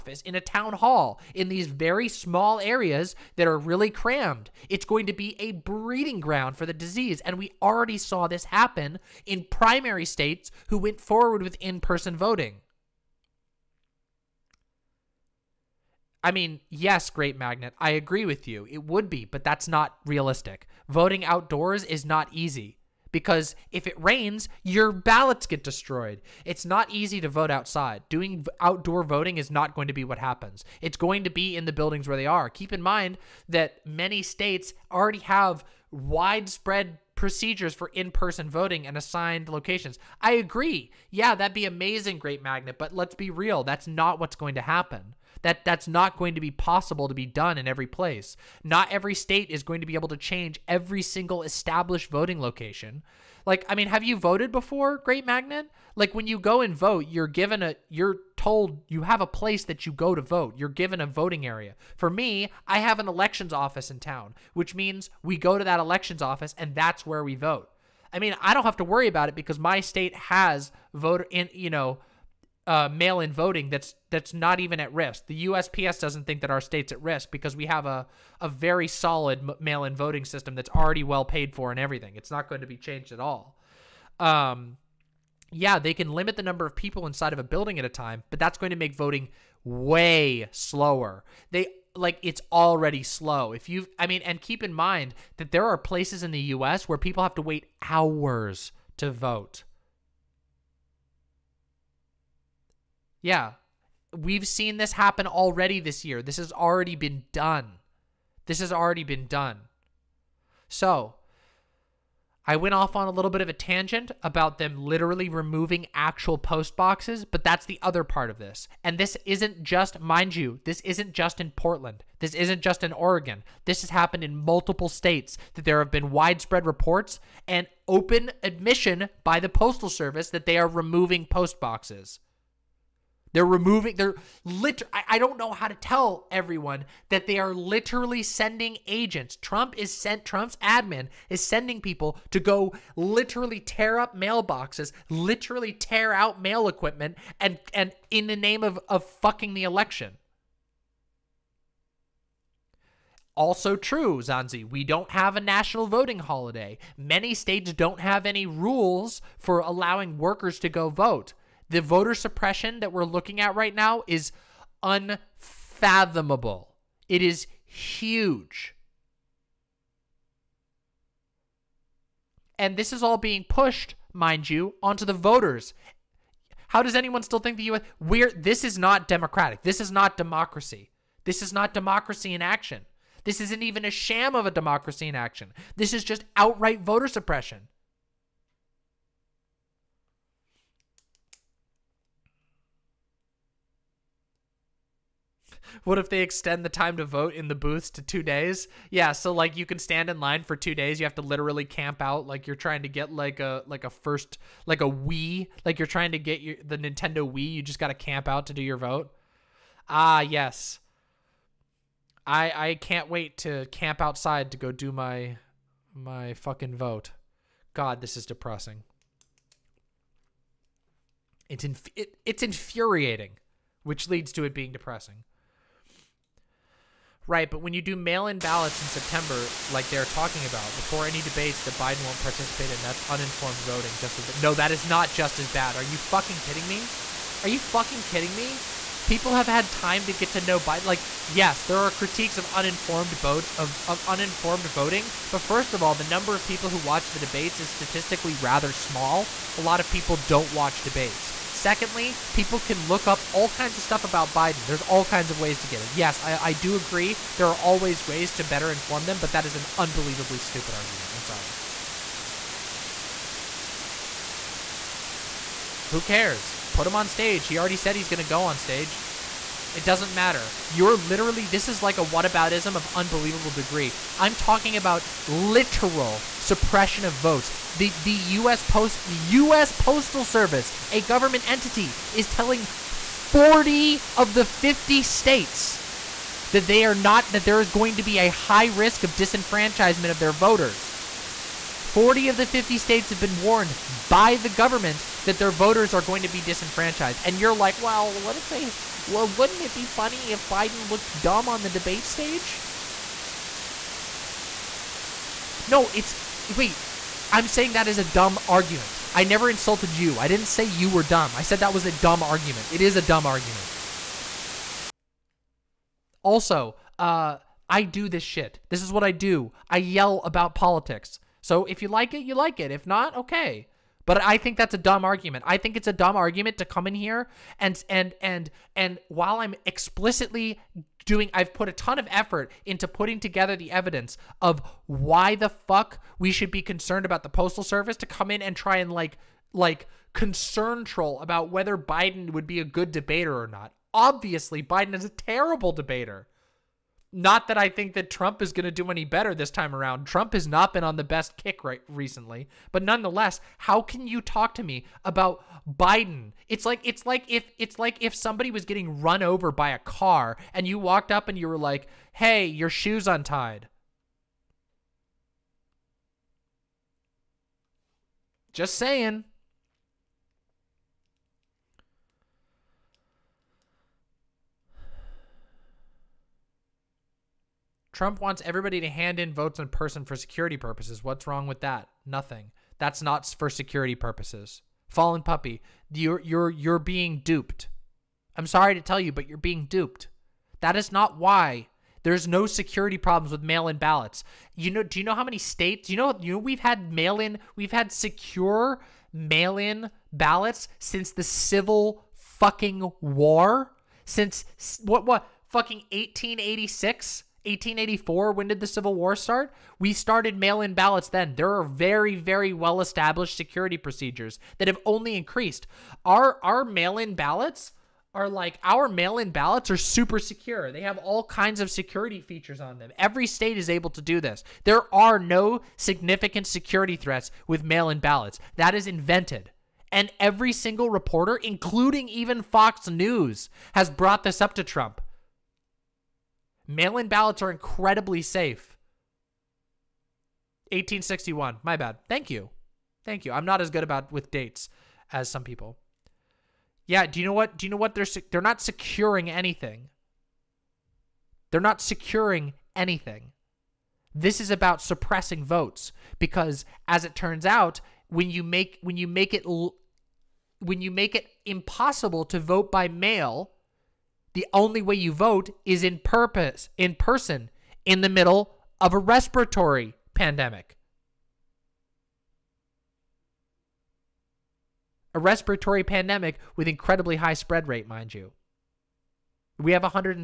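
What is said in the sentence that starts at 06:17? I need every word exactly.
Trump wants everybody to hand in votes in person for security purposes.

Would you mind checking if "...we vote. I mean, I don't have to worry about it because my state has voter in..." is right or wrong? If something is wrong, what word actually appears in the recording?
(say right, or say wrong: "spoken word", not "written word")
right.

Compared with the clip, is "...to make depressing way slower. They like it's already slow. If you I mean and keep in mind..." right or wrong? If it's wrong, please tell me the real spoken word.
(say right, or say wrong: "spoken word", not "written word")
wrong: "voting", not "depressing".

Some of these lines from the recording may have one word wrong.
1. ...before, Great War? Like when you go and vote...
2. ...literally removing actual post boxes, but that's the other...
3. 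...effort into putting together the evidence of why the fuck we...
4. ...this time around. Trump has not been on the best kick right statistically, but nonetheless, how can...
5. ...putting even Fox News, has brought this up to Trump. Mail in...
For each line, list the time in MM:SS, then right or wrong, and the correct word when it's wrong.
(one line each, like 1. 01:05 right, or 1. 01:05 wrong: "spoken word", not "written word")
1. 00:54 wrong: "Magnet", not "War"
2. 01:54 right
3. 05:32 right
4. 05:49 wrong: "recently", not "statistically"
5. 07:11 wrong: "including", not "putting".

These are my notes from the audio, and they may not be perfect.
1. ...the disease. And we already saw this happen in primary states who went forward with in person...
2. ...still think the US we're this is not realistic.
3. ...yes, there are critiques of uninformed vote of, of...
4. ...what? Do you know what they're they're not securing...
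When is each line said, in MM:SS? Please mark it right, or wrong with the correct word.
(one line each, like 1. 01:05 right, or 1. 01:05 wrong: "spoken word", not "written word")
1. 00:06 right
2. 02:57 wrong: "democratic", not "realistic"
3. 04:01 right
4. 07:27 right.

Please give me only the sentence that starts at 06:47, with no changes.
1884, when did the Civil War start?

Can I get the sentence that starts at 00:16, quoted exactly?
I mean, yes, Great Magnet, I agree with you.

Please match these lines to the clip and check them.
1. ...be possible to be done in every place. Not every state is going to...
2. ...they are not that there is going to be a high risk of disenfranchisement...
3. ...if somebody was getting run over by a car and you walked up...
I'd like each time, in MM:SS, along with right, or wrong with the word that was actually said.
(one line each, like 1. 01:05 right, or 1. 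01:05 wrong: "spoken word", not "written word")
1. 00:46 right
2. 04:46 right
3. 05:58 right.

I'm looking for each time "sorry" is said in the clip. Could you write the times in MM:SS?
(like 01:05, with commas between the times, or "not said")
04:21, 06:28.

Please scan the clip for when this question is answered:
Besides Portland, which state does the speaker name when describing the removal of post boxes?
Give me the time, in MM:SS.
02:02.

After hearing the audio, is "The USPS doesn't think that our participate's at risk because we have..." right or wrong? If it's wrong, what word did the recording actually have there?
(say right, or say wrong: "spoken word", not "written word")
wrong: "state", not "participate".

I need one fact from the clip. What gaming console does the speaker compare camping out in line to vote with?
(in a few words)
Nintendo Wii.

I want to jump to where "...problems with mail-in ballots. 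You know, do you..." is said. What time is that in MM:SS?
06:32.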